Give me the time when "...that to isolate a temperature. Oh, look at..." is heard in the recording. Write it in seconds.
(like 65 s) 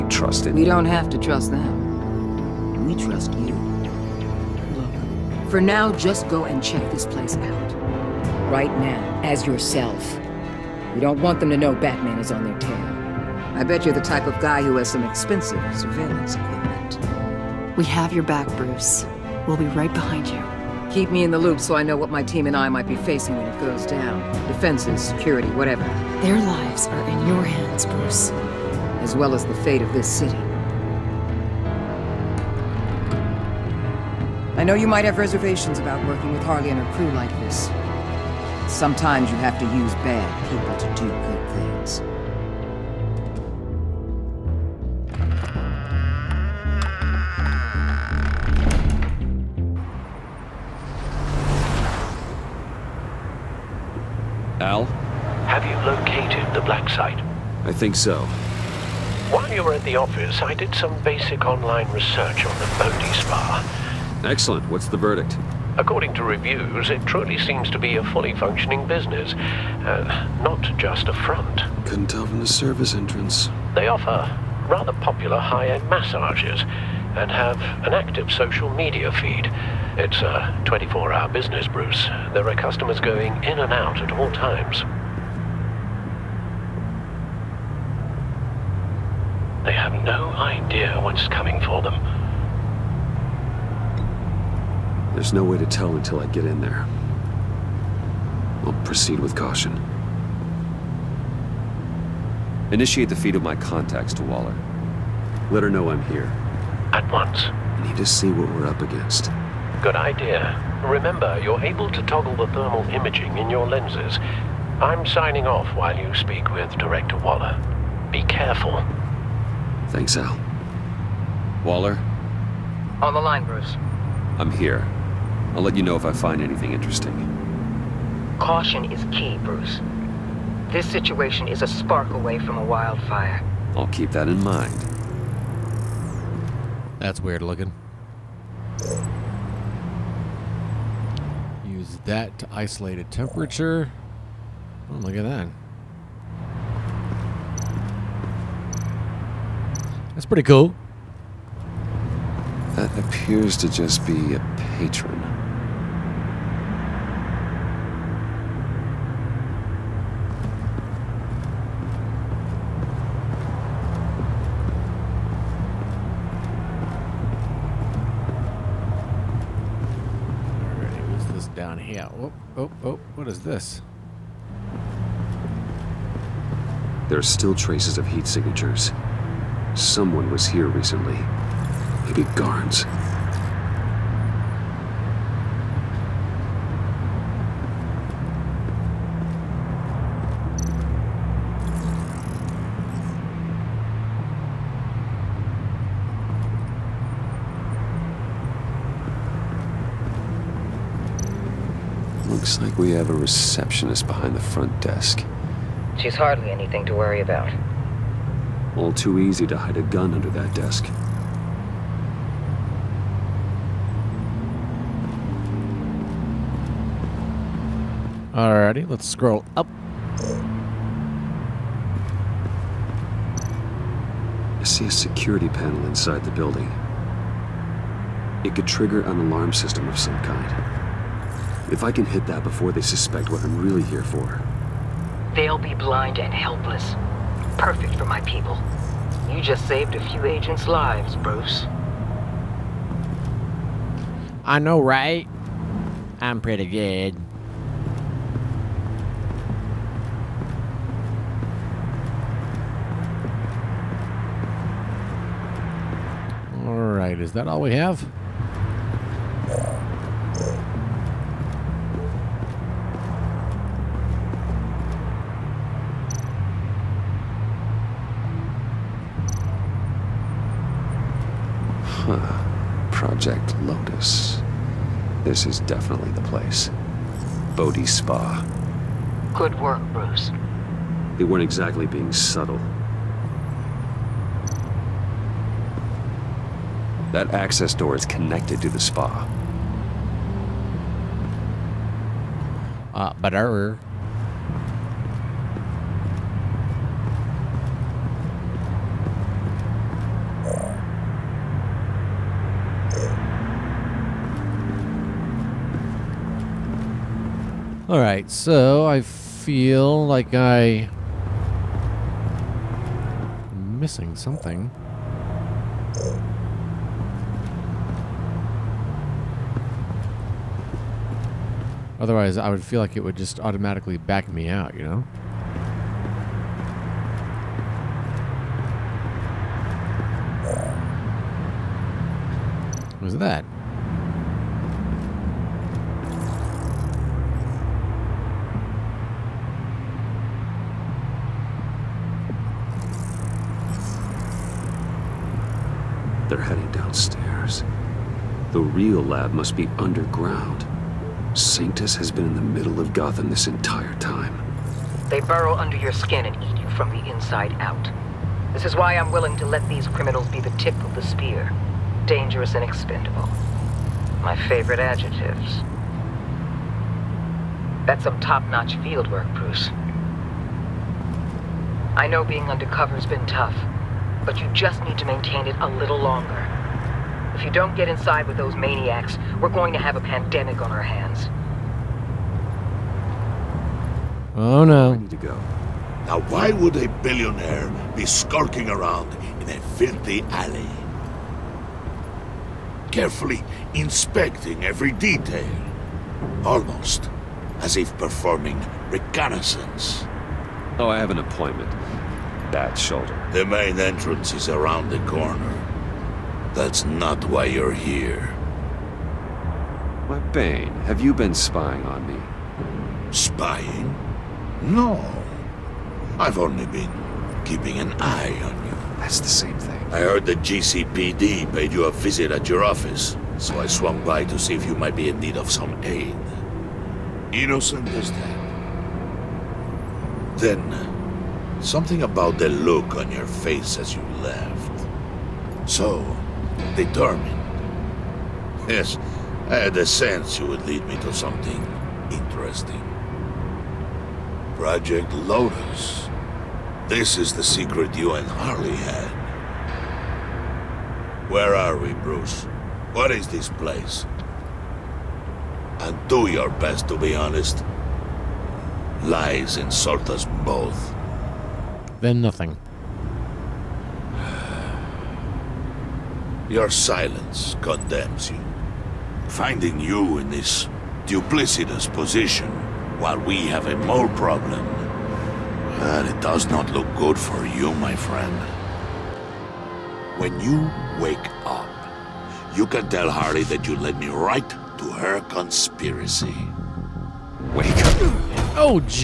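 142 s.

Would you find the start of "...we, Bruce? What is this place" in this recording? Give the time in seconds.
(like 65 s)
451 s.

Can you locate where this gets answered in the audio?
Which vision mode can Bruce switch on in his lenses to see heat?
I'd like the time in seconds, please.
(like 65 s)
112 s.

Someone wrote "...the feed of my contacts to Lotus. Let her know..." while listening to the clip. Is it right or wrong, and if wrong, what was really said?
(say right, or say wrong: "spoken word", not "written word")
wrong: "Waller", not "Lotus".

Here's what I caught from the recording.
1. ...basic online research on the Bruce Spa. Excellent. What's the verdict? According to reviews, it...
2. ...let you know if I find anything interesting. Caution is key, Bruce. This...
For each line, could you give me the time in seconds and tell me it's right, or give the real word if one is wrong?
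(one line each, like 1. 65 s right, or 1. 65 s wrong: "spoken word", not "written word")
1. 61 s wrong: "Bodhi", not "Bruce"
2. 125 s right.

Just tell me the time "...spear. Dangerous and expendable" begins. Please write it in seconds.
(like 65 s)
361 s.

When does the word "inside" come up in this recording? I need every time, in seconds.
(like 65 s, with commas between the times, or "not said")
225 s, 357 s, 377 s.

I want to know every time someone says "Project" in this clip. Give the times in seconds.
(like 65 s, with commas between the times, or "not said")
272 s, 444 s.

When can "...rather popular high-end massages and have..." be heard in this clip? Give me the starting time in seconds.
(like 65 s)
74 s.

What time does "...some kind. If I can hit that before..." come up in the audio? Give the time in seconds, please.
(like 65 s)
229 s.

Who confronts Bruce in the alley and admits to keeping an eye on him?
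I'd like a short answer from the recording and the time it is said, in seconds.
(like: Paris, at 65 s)
Bane, at 410 s.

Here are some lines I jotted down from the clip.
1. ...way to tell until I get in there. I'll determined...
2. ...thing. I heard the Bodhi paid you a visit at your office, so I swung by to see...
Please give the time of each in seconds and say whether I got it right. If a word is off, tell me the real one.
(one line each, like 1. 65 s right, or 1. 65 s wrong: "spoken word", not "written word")
1. 95 s wrong: "proceed", not "determined"
2. 419 s wrong: "GCPD", not "Bodhi".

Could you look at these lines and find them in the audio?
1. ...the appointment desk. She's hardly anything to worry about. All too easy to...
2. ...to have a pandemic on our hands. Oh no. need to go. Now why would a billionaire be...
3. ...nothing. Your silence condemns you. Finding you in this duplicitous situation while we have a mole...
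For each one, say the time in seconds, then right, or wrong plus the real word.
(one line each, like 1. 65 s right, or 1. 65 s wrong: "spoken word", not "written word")
1. 204 s wrong: "front", not "appointment"
2. 379 s right
3. 462 s wrong: "position", not "situation".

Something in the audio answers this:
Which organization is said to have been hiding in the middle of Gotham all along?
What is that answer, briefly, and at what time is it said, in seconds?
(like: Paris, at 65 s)
Sanctus, at 351 s.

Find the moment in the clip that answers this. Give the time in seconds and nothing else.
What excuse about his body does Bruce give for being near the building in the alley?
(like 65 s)
402 s.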